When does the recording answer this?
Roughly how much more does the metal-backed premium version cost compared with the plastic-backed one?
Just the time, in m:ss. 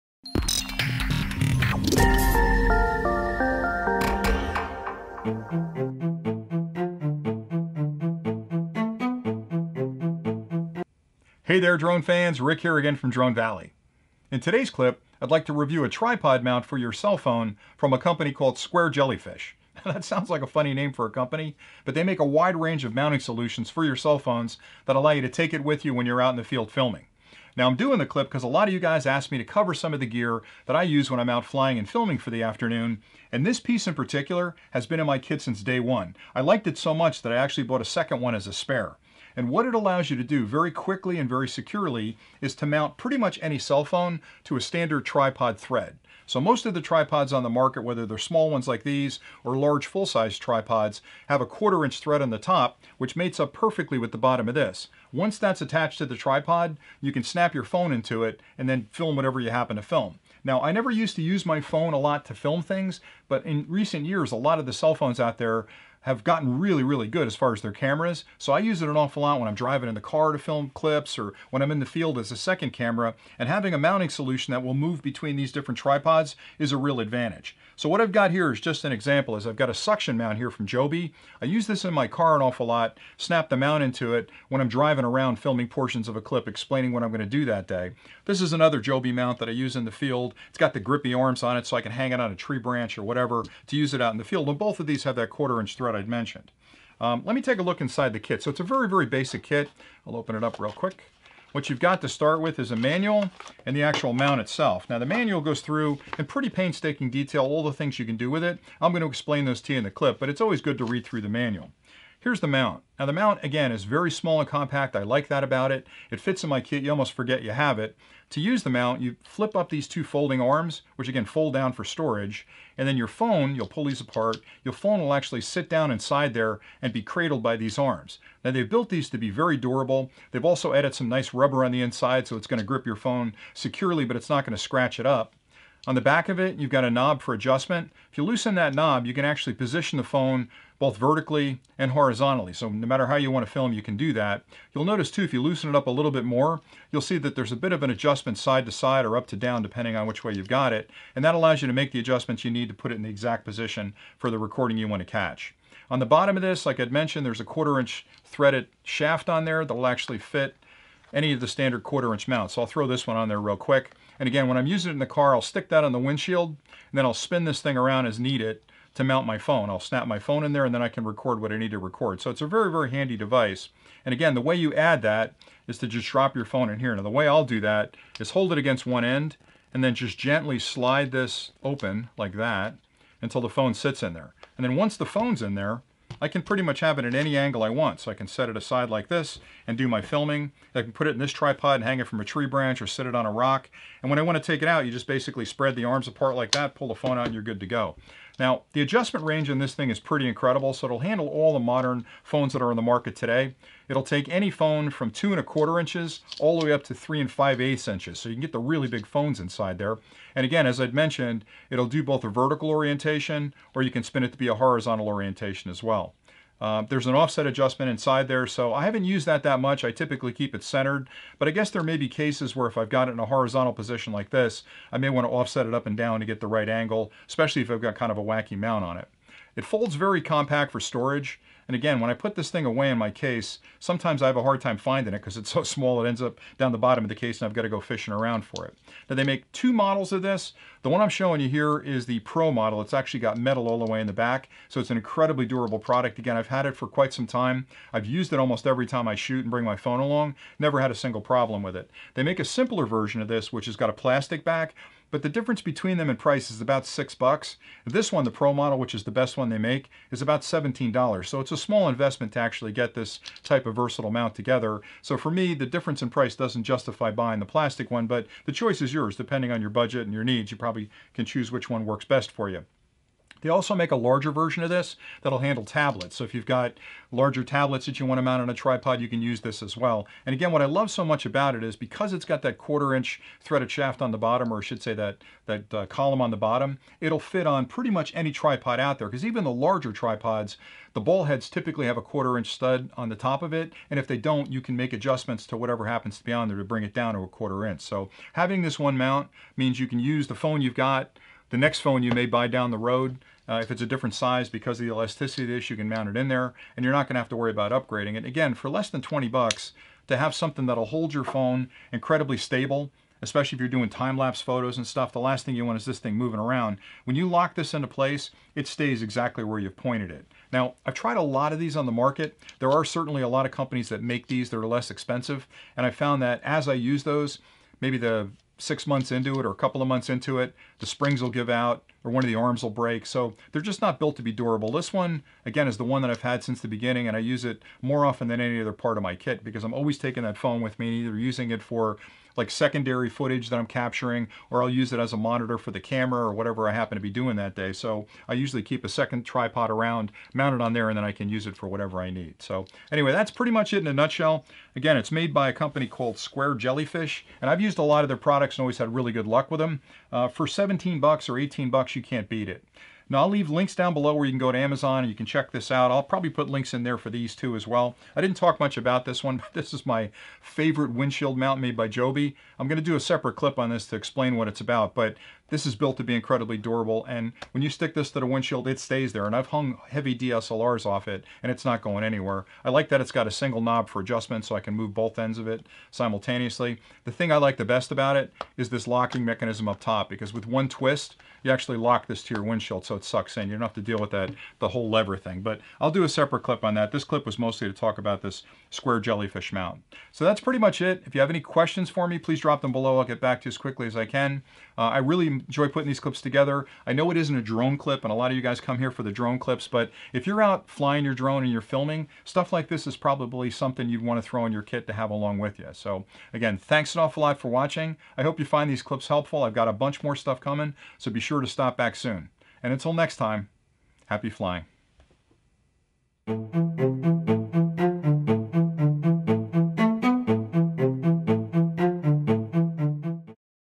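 4:16.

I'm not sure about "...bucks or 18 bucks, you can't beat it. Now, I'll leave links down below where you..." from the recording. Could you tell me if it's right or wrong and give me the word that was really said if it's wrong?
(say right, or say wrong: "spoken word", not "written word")
right.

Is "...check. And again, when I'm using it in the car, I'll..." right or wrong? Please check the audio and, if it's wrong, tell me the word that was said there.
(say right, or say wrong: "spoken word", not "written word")
wrong: "quick", not "check".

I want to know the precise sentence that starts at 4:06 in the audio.
Again, I've had it for quite some time.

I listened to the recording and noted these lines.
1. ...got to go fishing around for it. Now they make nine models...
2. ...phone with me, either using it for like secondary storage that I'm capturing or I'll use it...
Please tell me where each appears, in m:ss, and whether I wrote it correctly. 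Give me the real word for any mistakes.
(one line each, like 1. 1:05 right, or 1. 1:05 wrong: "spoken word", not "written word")
1. 3:57 wrong: "two", not "nine"
2. 5:40 wrong: "footage", not "storage".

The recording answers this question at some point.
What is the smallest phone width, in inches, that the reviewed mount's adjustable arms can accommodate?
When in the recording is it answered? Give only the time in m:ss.
3:25.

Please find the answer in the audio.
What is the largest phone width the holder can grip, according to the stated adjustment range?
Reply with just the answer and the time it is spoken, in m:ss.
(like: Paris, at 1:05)
3 5/8 inches, at 3:26.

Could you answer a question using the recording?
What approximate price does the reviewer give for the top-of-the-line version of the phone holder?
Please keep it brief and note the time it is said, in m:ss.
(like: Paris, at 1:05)
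$17, at 4:20.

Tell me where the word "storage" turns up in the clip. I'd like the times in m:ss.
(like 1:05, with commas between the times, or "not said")
2:01, 3:50.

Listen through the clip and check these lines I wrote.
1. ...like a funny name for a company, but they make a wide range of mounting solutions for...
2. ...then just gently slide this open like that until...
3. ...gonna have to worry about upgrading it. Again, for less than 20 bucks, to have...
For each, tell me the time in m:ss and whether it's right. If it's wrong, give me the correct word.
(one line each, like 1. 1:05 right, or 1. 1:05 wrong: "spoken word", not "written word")
1. 0:20 right
2. 2:59 right
3. 5:07 right.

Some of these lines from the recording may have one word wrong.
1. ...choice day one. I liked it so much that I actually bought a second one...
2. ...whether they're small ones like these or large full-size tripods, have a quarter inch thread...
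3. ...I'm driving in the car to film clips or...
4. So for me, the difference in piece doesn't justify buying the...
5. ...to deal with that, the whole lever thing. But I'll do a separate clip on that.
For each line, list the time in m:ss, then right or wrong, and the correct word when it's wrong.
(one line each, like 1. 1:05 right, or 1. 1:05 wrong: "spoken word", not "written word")
1. 0:35 wrong: "since", not "choice"
2. 0:47 right
3. 1:09 right
4. 4:25 wrong: "price", not "piece"
5. 6:33 right.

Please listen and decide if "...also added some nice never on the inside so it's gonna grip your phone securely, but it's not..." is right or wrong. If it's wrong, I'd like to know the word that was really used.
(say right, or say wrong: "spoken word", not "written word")
wrong: "rubber", not "never".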